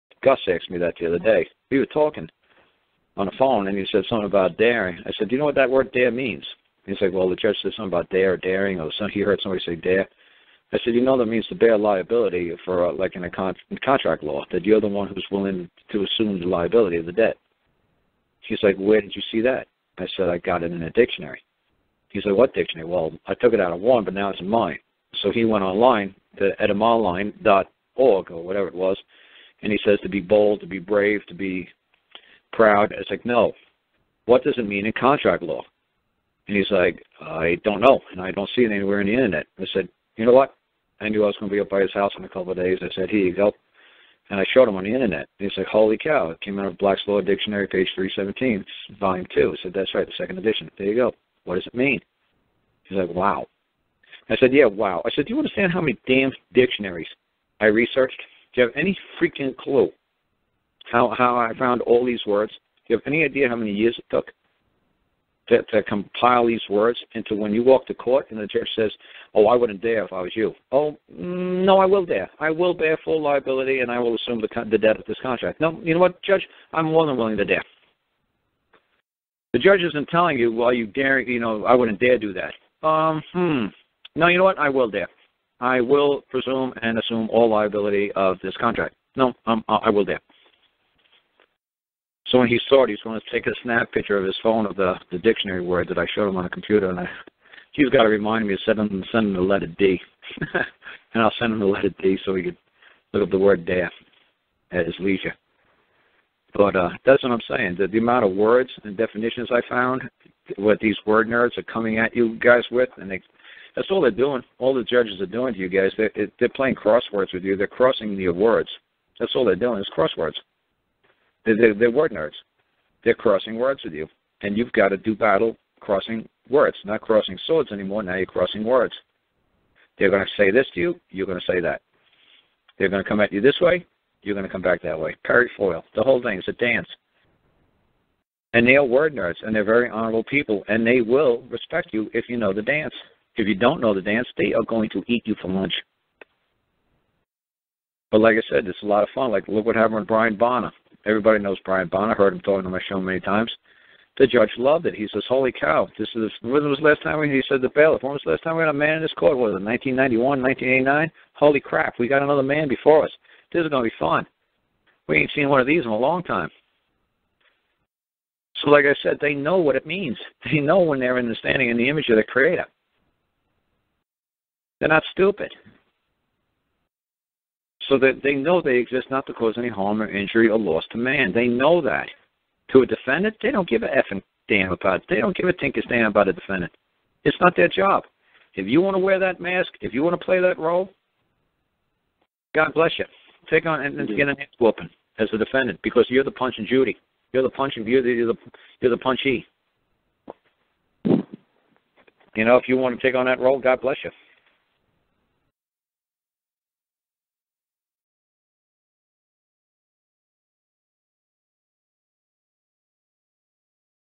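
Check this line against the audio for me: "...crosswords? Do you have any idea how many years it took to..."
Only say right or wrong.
wrong.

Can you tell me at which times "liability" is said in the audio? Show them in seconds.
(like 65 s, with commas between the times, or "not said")
11 s, 16 s, 73 s, 87 s.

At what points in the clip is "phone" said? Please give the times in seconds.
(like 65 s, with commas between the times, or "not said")
3 s, 94 s.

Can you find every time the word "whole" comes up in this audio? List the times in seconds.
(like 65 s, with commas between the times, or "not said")
136 s.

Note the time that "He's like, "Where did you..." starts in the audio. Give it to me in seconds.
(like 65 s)
18 s.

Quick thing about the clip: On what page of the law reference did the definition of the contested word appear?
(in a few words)
317.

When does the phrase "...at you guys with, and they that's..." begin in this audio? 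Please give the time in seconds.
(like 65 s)
111 s.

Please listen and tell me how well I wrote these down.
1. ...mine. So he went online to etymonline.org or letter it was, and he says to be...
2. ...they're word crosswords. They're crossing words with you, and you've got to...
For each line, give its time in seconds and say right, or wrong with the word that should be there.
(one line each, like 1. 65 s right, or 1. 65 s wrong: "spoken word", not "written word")
1. 24 s wrong: "whatever", not "letter"
2. 121 s wrong: "nerds", not "crosswords".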